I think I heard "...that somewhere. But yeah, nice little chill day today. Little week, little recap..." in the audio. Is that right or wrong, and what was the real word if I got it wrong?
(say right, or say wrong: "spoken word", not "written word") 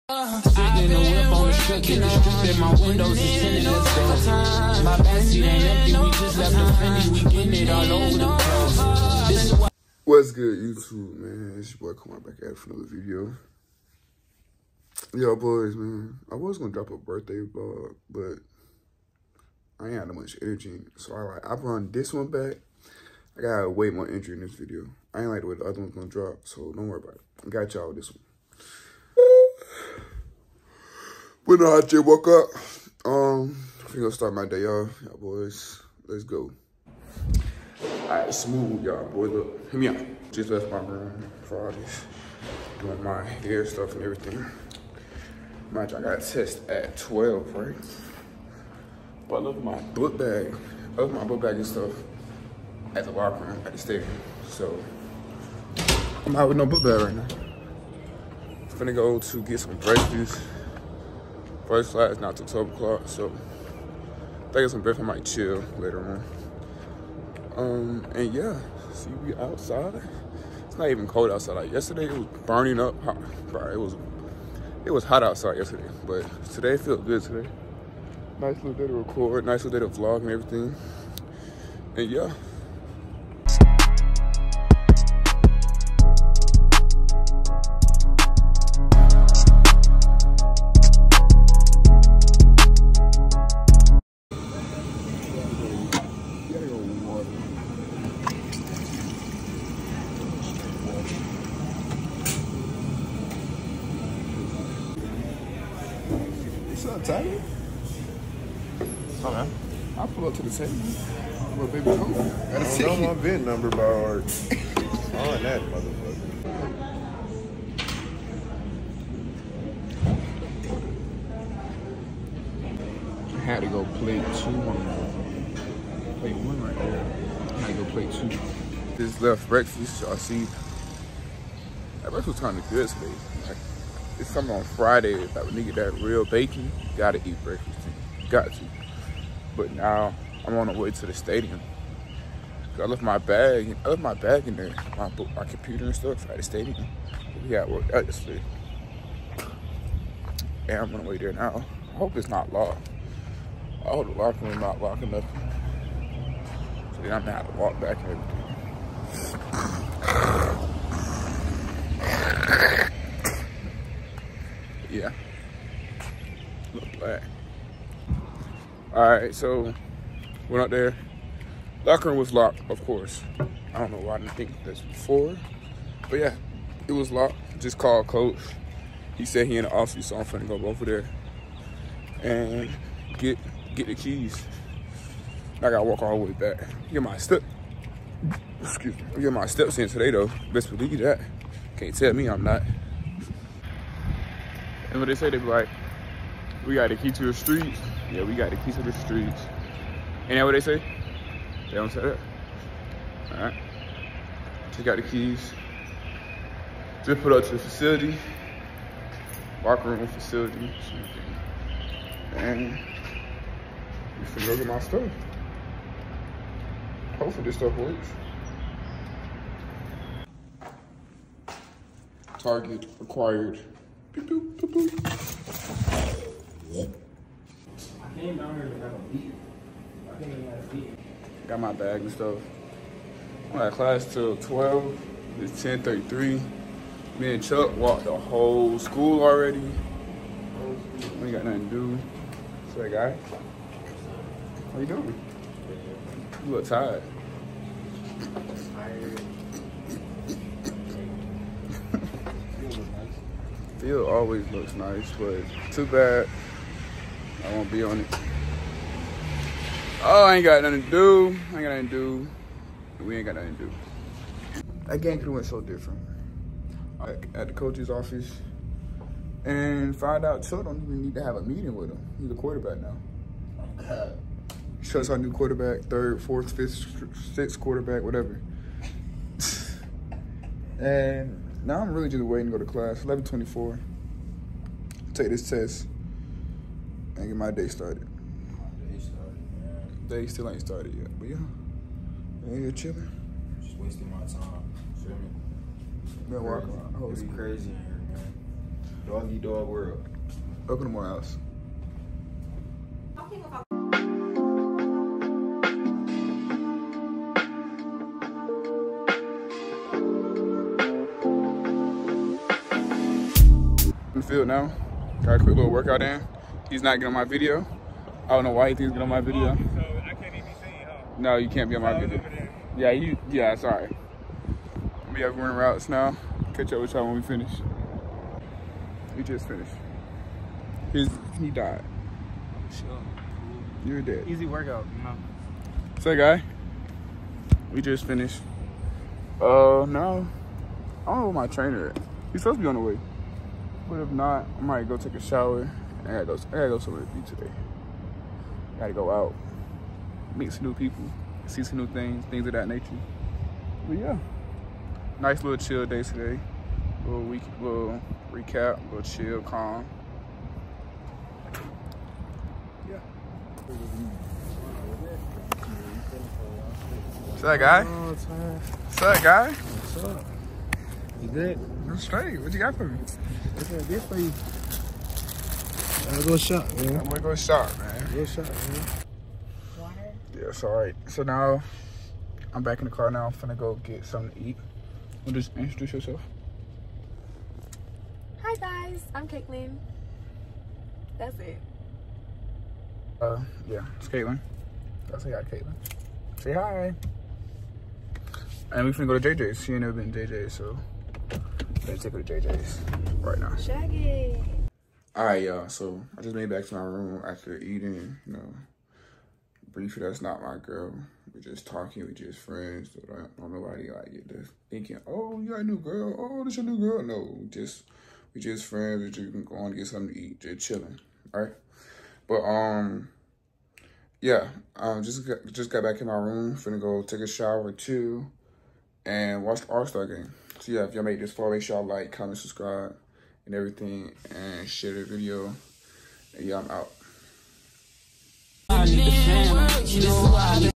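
wrong: "nature", not "somewhere".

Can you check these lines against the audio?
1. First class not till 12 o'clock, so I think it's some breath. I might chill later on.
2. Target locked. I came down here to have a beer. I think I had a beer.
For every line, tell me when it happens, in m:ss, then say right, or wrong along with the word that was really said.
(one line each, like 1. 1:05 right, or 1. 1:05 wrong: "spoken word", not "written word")
1. 1:01 right
2. 3:42 wrong: "acquired", not "locked".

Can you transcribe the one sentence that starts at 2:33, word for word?
I hope the locker room not locking up, so then I'm gonna have to walk back and everything.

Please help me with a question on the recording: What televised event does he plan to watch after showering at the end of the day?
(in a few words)
All Star game.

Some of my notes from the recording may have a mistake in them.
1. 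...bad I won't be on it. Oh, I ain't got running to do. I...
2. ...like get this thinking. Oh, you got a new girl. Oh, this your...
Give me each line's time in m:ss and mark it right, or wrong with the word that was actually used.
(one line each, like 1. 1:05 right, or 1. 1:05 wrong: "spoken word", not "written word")
1. 4:15 wrong: "nothing", not "running"
2. 6:53 right.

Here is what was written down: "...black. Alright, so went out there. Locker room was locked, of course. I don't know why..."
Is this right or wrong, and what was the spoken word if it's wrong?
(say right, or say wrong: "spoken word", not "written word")
right.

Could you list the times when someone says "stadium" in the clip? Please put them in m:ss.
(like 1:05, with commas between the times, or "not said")
0:53, 2:21, 2:26.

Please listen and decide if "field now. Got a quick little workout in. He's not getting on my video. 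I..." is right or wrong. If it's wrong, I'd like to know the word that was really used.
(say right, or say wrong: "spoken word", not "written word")
right.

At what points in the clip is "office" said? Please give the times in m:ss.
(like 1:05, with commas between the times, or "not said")
2:59, 4:27.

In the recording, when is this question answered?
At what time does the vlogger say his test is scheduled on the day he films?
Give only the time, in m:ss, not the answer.
0:45.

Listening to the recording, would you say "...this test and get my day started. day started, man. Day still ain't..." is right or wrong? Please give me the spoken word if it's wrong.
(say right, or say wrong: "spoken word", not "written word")
right.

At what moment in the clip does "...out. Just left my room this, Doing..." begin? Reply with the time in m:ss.
0:39.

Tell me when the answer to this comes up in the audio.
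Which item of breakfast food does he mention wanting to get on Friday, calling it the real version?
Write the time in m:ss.
2:15.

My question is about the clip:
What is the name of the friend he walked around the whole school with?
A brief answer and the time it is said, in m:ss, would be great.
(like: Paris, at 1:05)
Chuck, at 3:57.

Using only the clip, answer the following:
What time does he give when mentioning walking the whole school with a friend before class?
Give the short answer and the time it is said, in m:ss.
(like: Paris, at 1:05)
10:33, at 3:55.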